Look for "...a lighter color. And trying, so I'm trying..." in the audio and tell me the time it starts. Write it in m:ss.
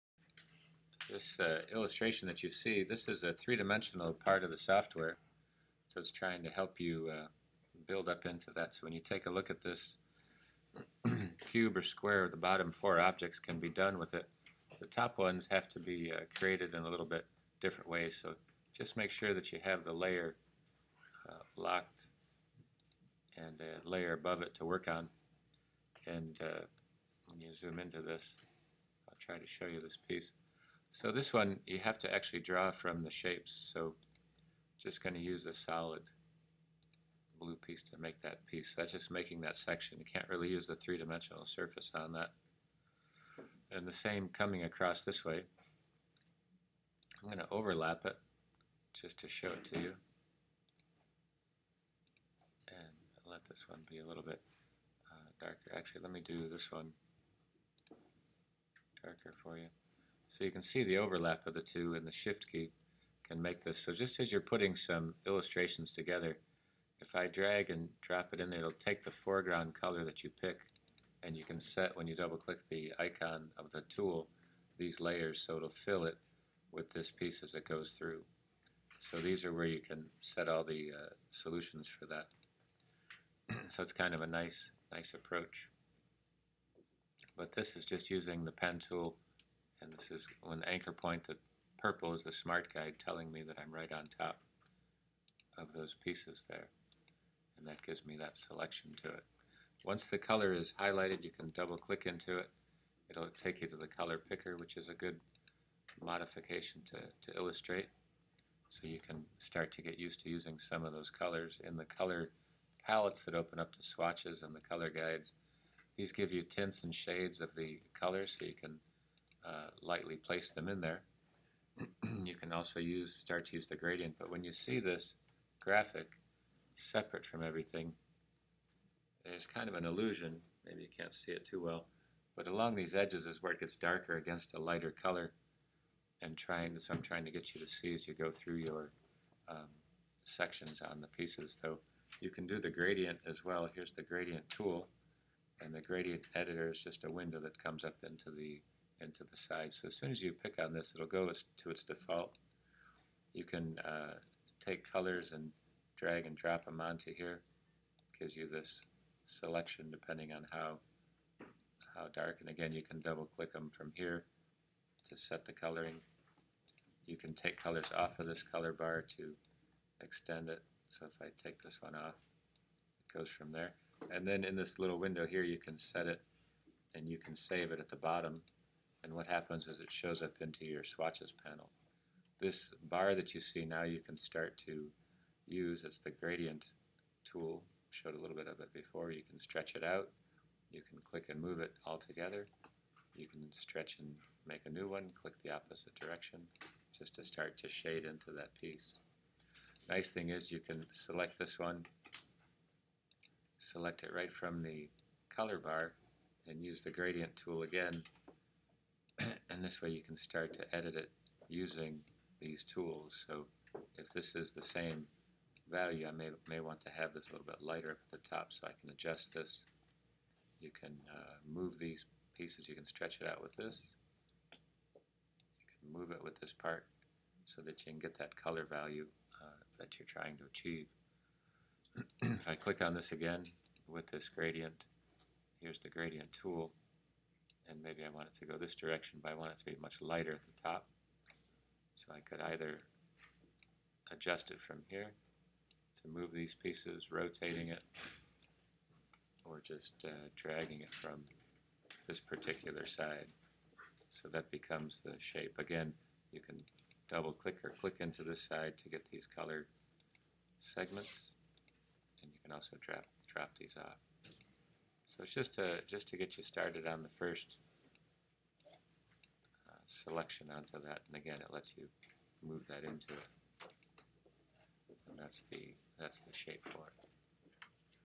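2:14.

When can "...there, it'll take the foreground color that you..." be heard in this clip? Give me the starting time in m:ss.
1:08.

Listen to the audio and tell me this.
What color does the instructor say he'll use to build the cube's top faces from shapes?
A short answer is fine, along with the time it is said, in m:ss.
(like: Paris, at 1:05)
solid blue, at 0:35.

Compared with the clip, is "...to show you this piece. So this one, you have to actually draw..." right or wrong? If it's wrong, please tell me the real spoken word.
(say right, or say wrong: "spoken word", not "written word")
right.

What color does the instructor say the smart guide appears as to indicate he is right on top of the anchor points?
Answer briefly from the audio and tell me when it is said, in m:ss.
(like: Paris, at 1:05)
purple, at 1:31.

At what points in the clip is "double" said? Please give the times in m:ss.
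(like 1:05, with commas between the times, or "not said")
1:12, 1:41, 2:42, 4:17.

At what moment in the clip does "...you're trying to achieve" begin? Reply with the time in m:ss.
3:49.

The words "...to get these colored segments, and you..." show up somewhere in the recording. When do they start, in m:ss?
4:18.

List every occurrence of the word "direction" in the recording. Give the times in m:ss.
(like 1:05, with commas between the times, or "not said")
3:15, 3:58.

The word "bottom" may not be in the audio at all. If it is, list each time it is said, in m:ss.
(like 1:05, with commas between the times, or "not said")
0:12, 2:57.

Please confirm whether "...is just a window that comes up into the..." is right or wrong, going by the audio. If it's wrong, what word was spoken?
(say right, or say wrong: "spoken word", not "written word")
right.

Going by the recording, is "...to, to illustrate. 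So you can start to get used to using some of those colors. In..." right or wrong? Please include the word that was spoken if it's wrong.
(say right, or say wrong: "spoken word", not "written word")
right.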